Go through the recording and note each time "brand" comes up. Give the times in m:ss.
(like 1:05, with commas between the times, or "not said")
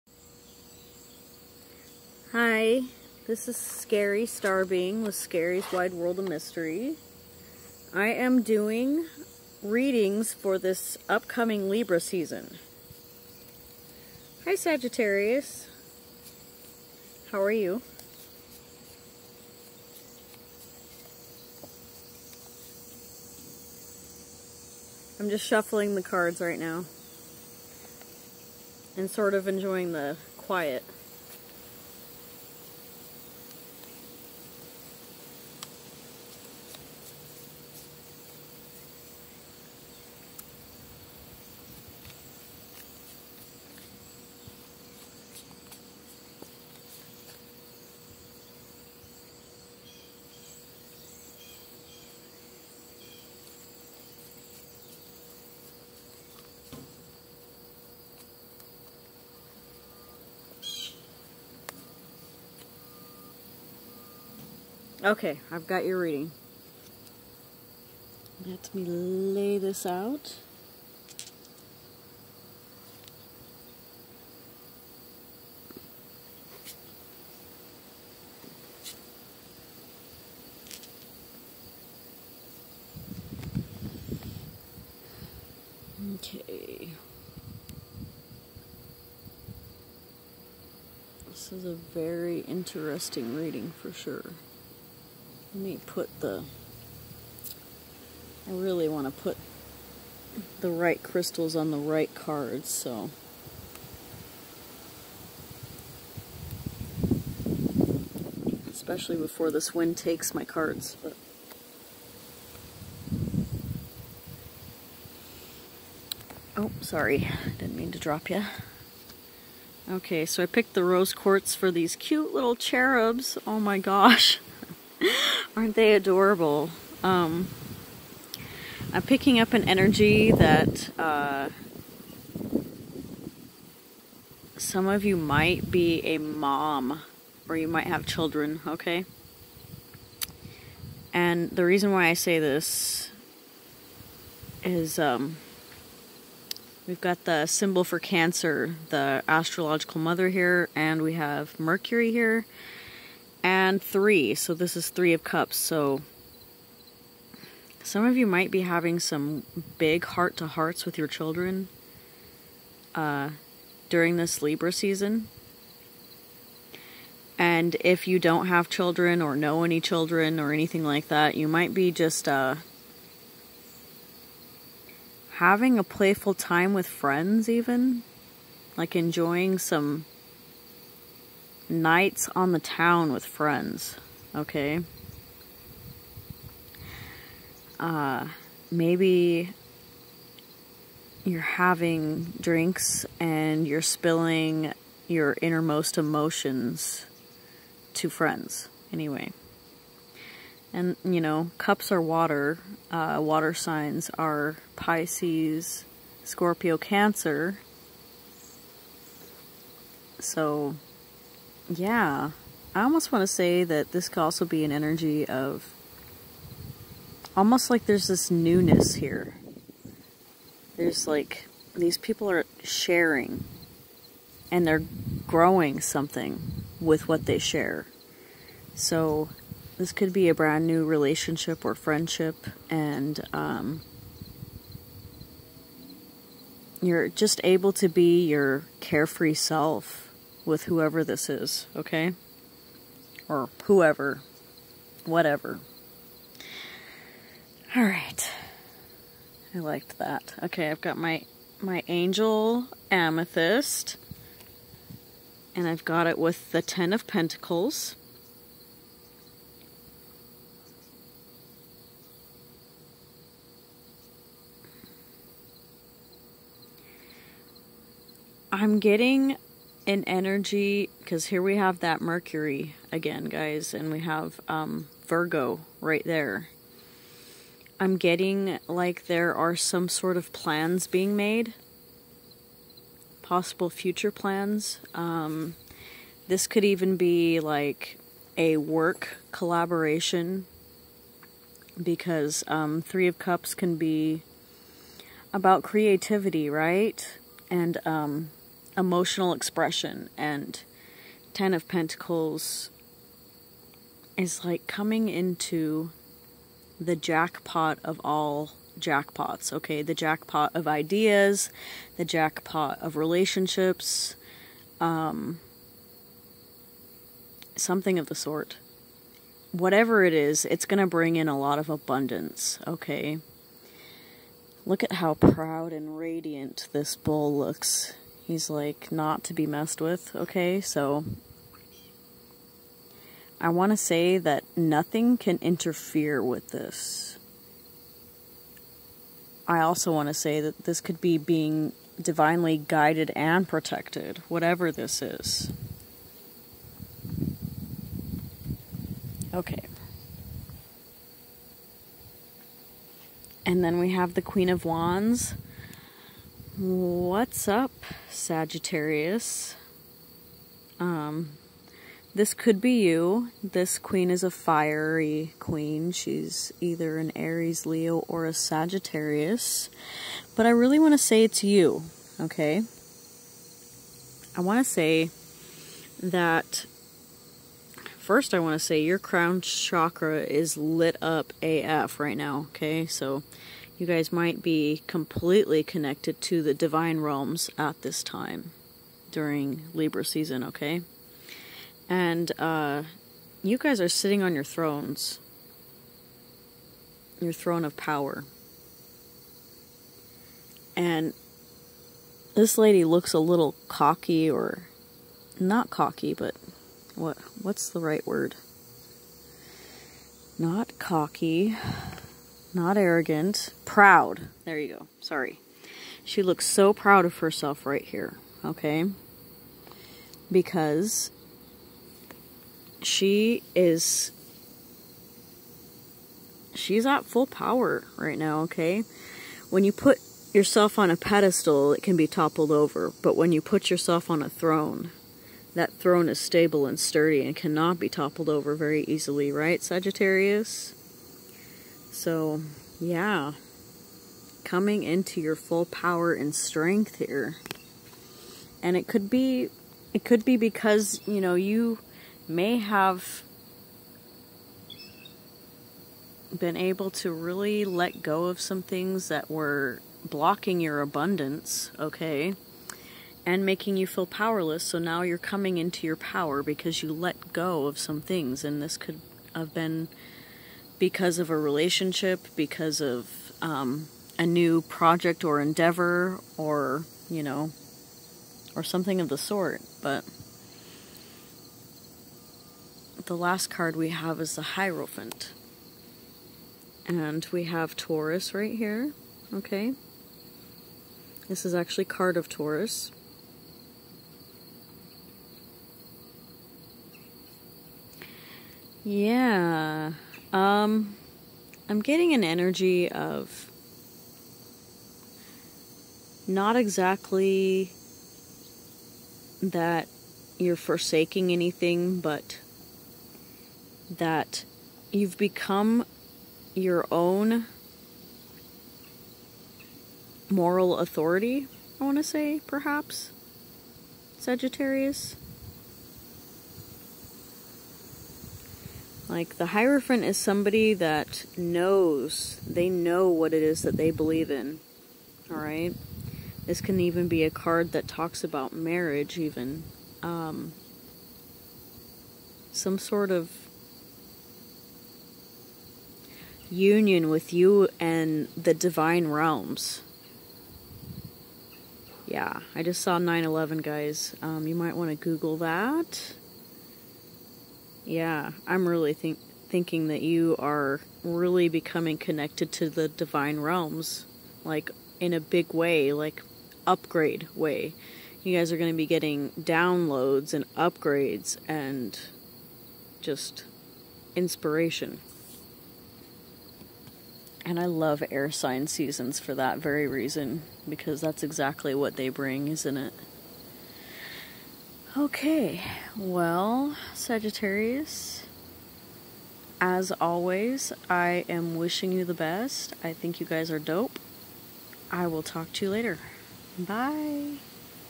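3:50.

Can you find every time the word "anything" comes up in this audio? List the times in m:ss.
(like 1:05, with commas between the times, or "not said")
2:50, 8:31.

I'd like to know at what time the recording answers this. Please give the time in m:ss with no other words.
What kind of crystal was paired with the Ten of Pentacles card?
4:11.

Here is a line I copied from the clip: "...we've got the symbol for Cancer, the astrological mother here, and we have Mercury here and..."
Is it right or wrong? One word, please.
right.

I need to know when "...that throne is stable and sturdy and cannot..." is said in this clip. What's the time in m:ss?
7:15.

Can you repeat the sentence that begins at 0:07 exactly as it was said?
I am doing readings for this upcoming Libra season.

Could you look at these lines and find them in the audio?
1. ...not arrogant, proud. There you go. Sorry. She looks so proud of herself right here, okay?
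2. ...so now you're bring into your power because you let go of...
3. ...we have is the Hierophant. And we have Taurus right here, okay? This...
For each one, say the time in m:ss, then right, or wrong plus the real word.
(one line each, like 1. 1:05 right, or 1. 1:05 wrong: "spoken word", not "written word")
1. 6:52 right
2. 7:44 wrong: "coming", not "bring"
3. 8:03 right.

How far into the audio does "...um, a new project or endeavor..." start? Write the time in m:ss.
7:53.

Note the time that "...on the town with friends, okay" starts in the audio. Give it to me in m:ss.
3:02.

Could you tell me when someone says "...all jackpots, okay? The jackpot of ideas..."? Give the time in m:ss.
5:08.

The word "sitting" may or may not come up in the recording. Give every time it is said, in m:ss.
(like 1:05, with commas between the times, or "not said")
6:33.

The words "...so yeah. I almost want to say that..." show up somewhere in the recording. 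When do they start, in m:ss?
3:30.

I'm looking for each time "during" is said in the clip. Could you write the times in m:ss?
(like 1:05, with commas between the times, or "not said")
2:43, 6:29.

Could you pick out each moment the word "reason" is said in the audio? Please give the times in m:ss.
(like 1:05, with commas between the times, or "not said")
2:21, 9:39.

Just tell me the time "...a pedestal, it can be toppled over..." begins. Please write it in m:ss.
7:10.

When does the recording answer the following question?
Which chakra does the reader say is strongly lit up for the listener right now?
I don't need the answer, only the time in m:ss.
6:18.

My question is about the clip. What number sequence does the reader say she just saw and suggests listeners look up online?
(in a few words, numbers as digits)
911.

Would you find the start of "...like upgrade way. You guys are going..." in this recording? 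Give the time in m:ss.
9:25.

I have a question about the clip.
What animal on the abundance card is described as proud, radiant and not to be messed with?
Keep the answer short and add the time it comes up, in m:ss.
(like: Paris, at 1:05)
Bull, at 5:26.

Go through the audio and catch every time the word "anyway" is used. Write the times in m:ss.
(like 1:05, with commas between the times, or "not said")
3:18.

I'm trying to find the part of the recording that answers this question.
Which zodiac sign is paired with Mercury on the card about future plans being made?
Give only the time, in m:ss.
4:35.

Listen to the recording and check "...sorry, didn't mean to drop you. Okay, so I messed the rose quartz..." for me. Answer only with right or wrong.
wrong.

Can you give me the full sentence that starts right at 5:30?
So I want to say that nothing can interfere with this.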